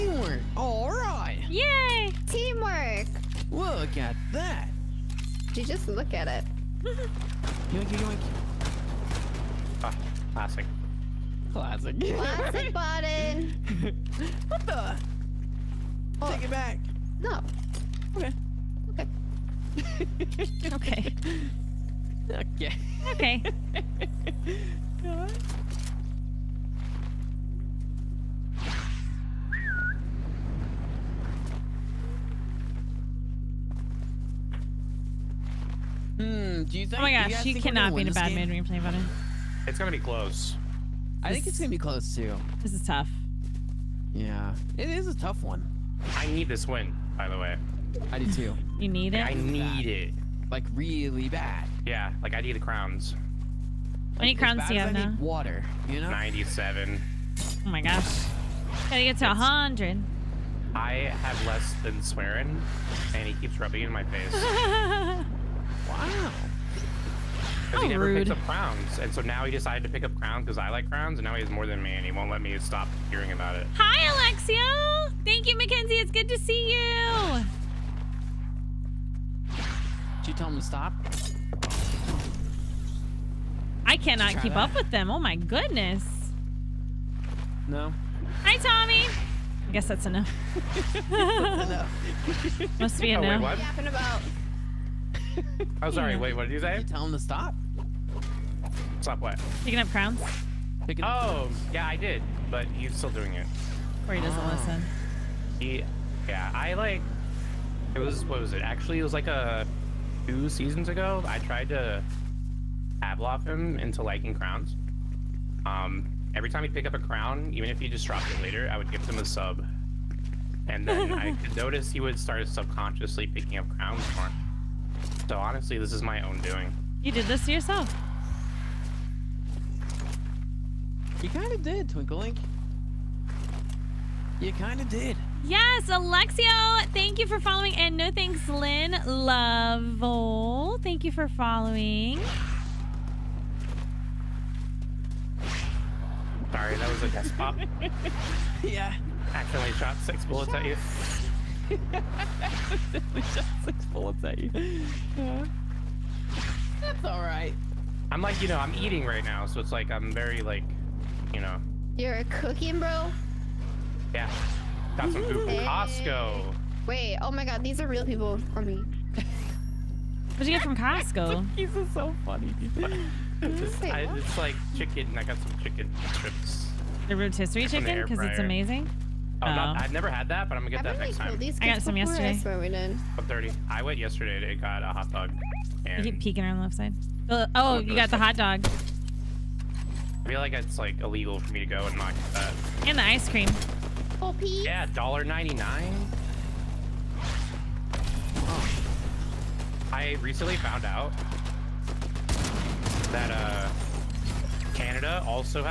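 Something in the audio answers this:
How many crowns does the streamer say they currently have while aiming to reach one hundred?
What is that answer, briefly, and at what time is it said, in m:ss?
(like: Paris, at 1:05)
97, at 0:56.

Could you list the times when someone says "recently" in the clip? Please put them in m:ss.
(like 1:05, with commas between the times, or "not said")
3:20.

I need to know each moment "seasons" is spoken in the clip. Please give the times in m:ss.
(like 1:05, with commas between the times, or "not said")
1:50.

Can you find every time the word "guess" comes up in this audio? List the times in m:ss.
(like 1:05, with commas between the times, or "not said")
1:29, 2:27.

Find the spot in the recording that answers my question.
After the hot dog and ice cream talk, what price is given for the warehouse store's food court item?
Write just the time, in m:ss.
3:14.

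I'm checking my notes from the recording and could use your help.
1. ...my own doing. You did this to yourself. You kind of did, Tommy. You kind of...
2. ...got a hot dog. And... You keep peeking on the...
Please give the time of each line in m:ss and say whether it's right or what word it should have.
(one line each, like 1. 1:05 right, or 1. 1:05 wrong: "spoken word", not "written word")
1. 2:06 wrong: "Twinklelink", not "Tommy"
2. 3:04 right.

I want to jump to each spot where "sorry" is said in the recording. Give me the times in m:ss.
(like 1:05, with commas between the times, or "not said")
1:35, 2:26.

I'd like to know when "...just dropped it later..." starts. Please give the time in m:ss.
1:57.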